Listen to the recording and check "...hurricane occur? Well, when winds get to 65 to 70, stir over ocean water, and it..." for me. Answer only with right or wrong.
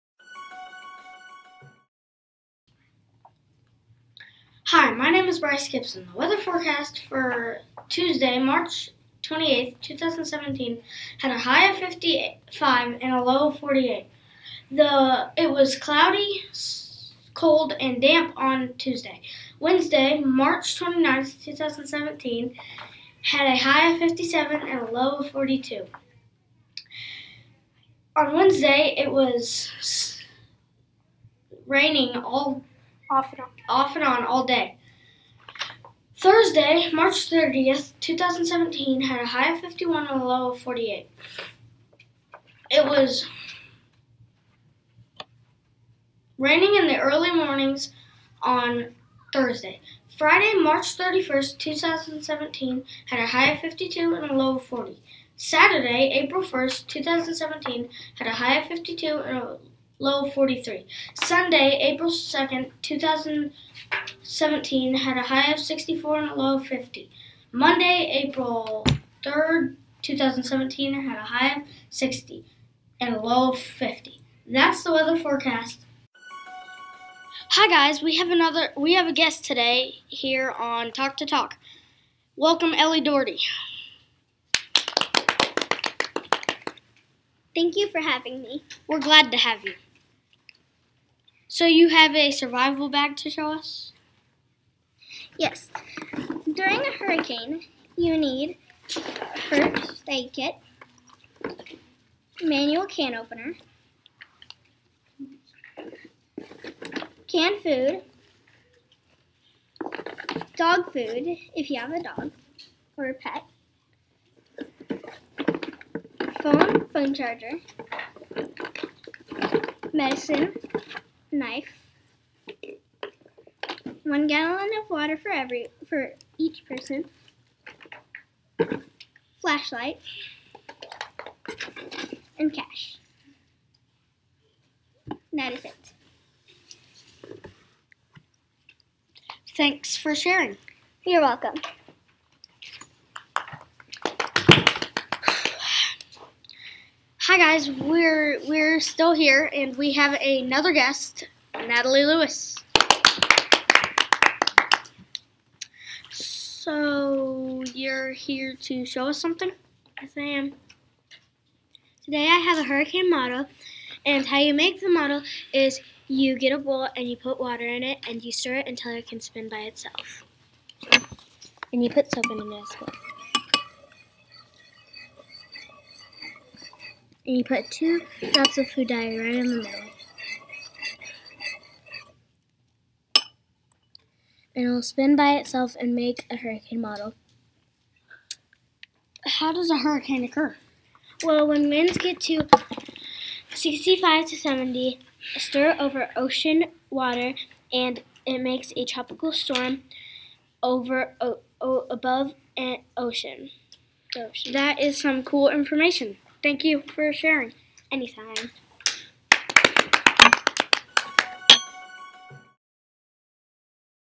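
right.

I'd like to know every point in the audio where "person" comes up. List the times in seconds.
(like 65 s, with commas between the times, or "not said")
126 s.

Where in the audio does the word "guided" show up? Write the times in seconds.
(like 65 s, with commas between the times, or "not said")
not said.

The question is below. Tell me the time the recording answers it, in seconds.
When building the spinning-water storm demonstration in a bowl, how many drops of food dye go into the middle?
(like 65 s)
177 s.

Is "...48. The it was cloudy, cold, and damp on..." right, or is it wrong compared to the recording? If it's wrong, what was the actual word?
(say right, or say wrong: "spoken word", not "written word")
right.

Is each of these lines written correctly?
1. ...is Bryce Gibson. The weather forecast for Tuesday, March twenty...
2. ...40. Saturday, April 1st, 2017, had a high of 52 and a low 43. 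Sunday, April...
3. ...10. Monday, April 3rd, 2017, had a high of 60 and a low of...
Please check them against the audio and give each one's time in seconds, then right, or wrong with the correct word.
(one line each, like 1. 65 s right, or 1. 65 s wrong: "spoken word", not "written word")
1. 5 s right
2. 54 s right
3. 66 s wrong: "50", not "10".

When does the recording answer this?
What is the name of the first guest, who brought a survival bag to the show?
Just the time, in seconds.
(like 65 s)
82 s.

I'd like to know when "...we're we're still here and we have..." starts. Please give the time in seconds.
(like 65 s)
147 s.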